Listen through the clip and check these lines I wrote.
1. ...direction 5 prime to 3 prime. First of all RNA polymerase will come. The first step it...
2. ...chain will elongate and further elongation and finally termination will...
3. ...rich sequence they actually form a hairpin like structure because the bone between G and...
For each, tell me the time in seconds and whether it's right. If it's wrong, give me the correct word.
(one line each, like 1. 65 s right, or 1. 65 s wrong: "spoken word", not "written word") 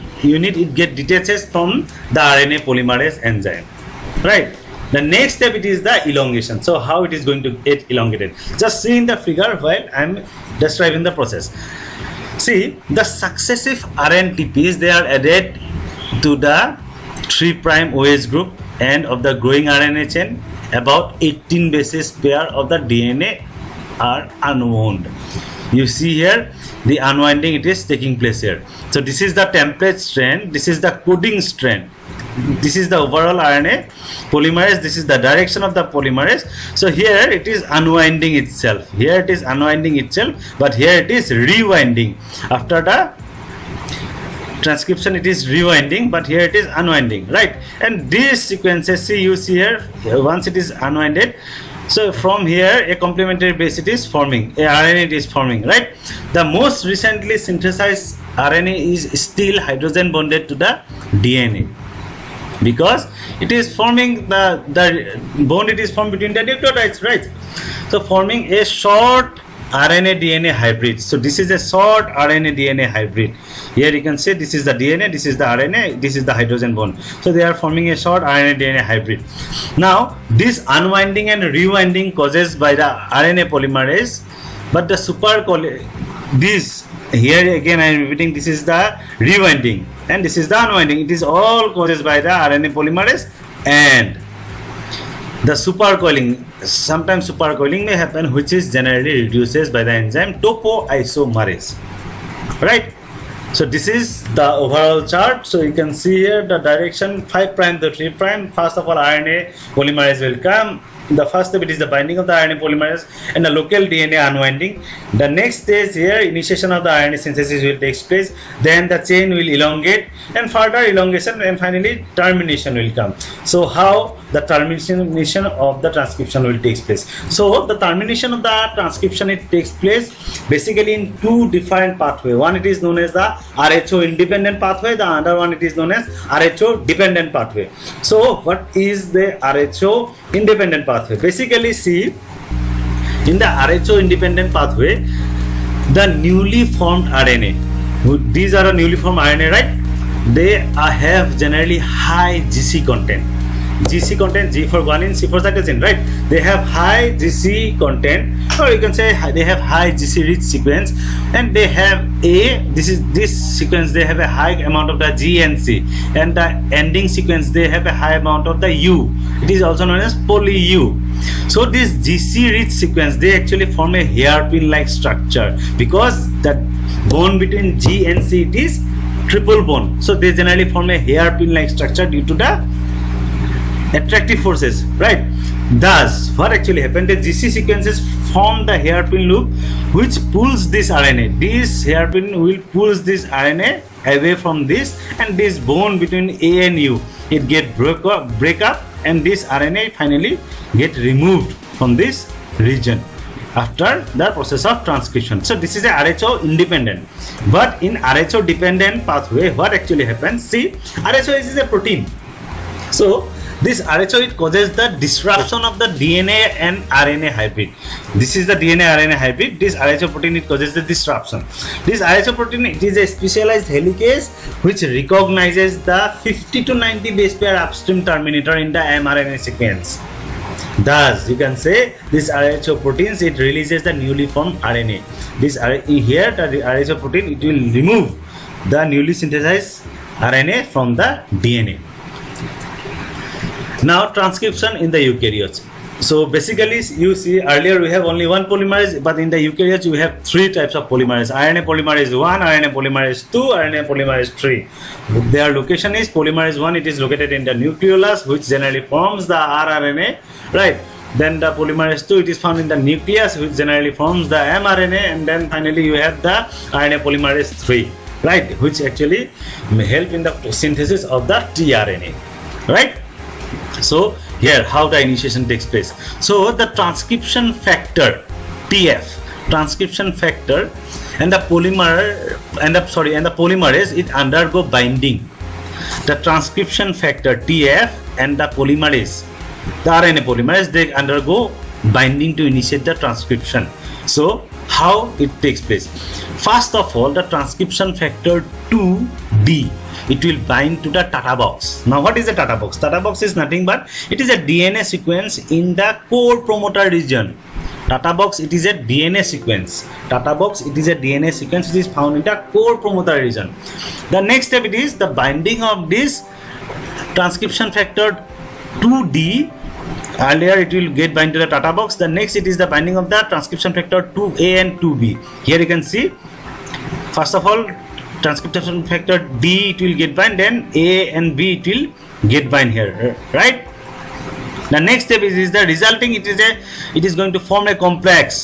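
1. 106 s right
2. 119 s right
3. 172 s right.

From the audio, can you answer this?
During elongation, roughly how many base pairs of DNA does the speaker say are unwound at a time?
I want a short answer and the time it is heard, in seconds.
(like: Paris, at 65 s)
18, at 21 s.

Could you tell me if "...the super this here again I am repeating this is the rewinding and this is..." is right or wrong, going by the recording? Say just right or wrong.
right.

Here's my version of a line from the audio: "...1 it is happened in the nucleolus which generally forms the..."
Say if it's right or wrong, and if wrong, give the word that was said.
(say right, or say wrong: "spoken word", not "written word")
wrong: "located", not "happened".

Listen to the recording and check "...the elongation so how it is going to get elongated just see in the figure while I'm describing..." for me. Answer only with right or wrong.
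right.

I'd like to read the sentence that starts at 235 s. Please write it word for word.
This here the RHO protein it will remove the newly synthesized RNA from the DNA.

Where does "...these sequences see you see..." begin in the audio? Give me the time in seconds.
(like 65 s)
48 s.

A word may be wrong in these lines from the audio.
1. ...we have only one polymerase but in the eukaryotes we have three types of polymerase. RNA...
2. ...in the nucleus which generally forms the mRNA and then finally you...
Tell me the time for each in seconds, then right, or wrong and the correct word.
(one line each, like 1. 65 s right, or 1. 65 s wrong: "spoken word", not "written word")
1. 247 s right
2. 262 s right.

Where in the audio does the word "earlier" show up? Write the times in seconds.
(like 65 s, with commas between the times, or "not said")
247 s, 320 s.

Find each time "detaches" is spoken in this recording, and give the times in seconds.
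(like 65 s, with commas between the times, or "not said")
0 s.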